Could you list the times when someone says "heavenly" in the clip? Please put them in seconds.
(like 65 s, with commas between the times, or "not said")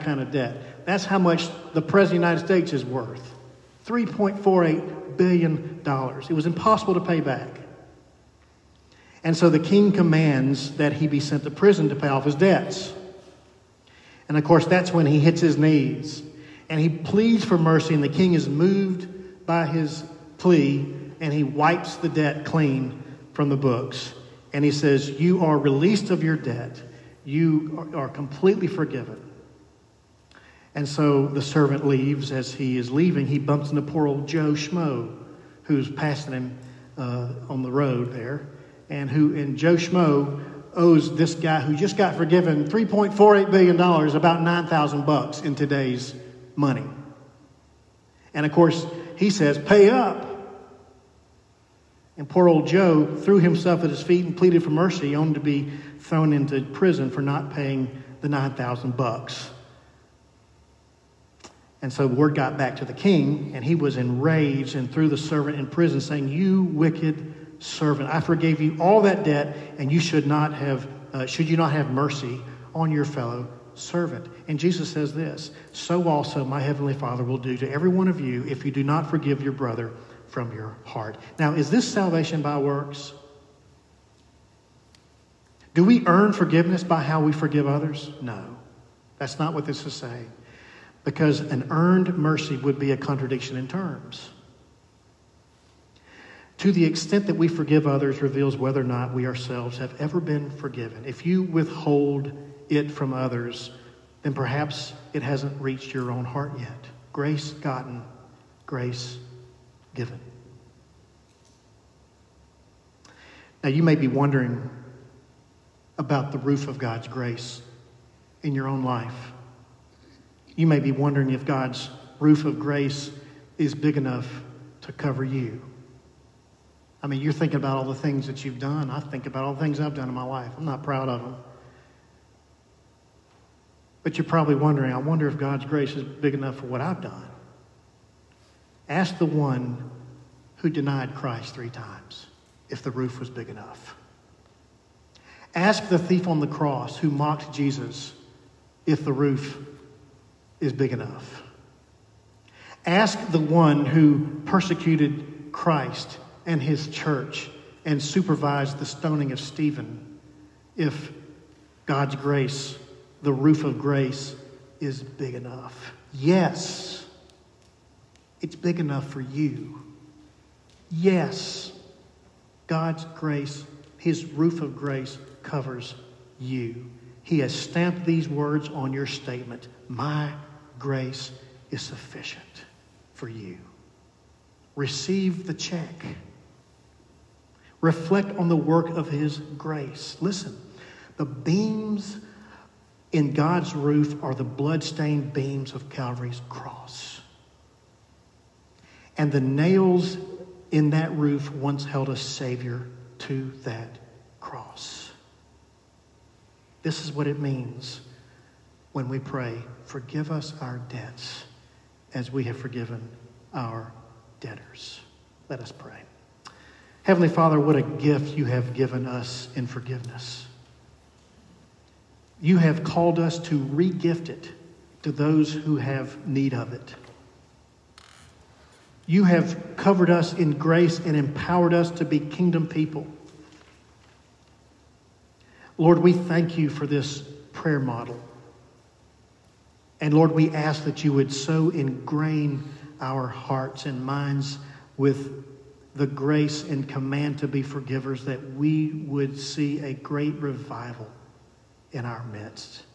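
76 s, 217 s.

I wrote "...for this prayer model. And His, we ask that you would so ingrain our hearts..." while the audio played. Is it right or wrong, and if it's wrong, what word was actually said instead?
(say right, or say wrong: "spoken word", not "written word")
wrong: "Lord", not "His".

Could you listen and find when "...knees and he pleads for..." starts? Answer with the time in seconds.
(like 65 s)
15 s.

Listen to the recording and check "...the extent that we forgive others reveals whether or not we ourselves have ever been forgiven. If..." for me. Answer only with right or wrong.
right.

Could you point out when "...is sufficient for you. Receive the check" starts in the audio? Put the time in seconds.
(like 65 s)
181 s.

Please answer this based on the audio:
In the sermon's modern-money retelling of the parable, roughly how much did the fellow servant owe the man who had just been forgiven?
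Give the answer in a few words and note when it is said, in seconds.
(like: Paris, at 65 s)
$9,000, at 44 s.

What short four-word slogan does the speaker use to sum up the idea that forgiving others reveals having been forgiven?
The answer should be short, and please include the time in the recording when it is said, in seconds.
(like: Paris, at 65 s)
Grace gotten, grace given, at 107 s.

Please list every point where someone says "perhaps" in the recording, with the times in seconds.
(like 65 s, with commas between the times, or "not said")
104 s.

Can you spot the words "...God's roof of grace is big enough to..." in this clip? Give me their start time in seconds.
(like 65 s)
121 s.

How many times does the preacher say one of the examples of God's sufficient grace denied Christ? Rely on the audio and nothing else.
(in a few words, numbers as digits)
3.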